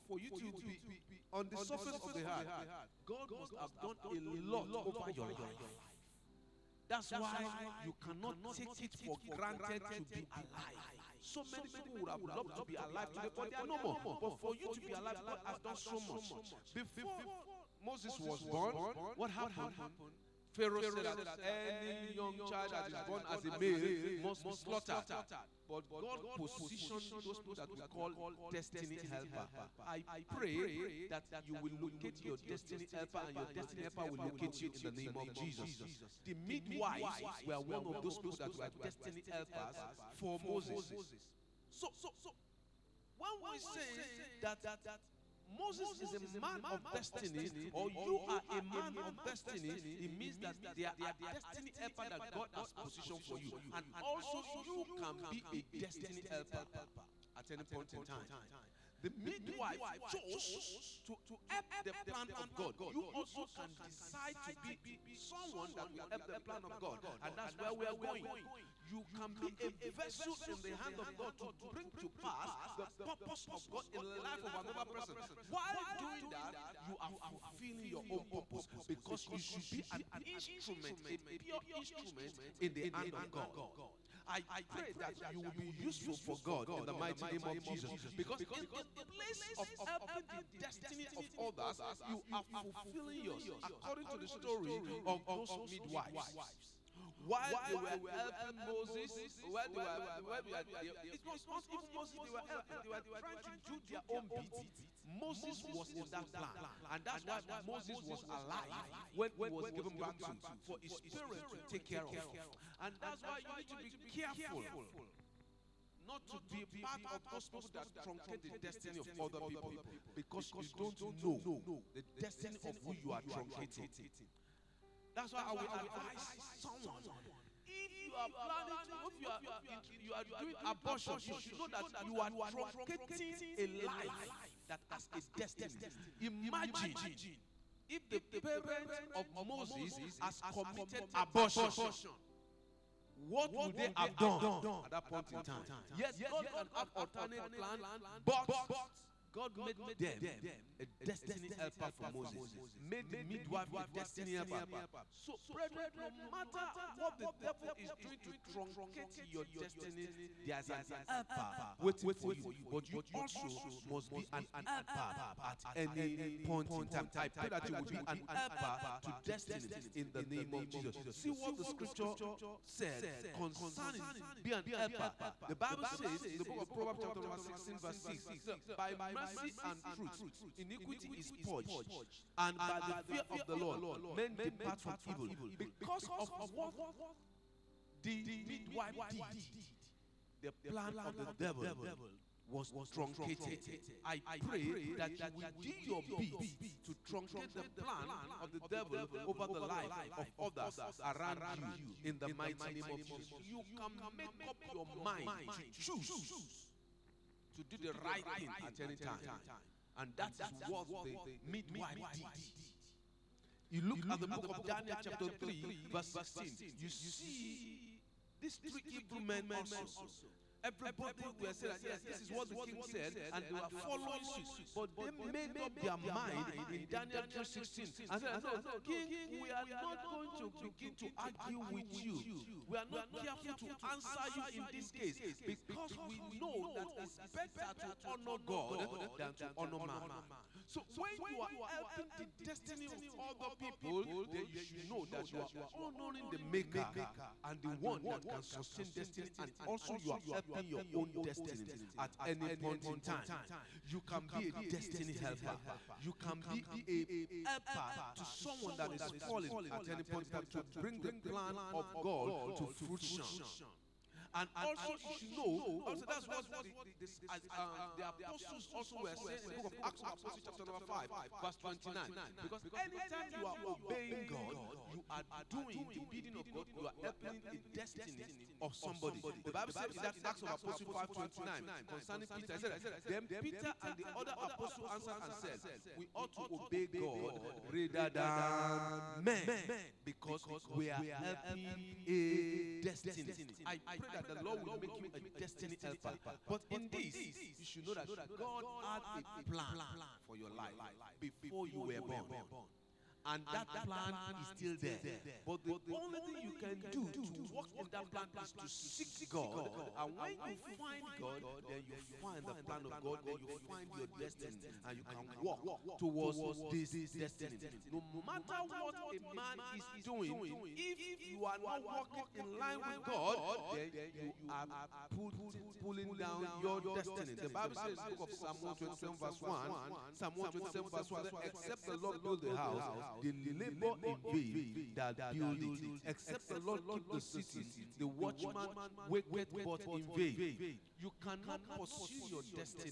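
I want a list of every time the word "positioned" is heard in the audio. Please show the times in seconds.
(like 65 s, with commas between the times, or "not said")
26 s, 52 s.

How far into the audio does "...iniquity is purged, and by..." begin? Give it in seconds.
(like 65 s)
180 s.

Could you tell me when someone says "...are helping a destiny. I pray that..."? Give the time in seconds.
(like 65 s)
290 s.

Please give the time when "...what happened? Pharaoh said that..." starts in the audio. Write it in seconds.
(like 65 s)
19 s.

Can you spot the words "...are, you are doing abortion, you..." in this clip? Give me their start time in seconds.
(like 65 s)
129 s.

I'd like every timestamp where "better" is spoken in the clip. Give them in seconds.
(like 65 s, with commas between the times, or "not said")
237 s.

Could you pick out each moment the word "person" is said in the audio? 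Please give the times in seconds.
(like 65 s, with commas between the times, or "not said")
74 s.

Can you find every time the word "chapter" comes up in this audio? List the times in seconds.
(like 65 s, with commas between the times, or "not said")
177 s, 215 s, 270 s.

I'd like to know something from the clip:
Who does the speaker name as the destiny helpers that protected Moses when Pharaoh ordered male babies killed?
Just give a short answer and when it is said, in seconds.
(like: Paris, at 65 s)
The midwives, at 36 s.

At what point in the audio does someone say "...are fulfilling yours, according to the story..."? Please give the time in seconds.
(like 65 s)
92 s.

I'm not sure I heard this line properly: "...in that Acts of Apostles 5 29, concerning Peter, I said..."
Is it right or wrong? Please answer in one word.
right.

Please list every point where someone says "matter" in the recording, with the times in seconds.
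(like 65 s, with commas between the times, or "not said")
156 s, 318 s.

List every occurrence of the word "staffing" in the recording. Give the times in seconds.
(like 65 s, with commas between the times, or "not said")
not said.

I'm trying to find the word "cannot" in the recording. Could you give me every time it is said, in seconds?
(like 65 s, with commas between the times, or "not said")
8 s, 341 s.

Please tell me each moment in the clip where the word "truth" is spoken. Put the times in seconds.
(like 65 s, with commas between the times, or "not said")
179 s.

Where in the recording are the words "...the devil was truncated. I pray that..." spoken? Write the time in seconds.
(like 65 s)
191 s.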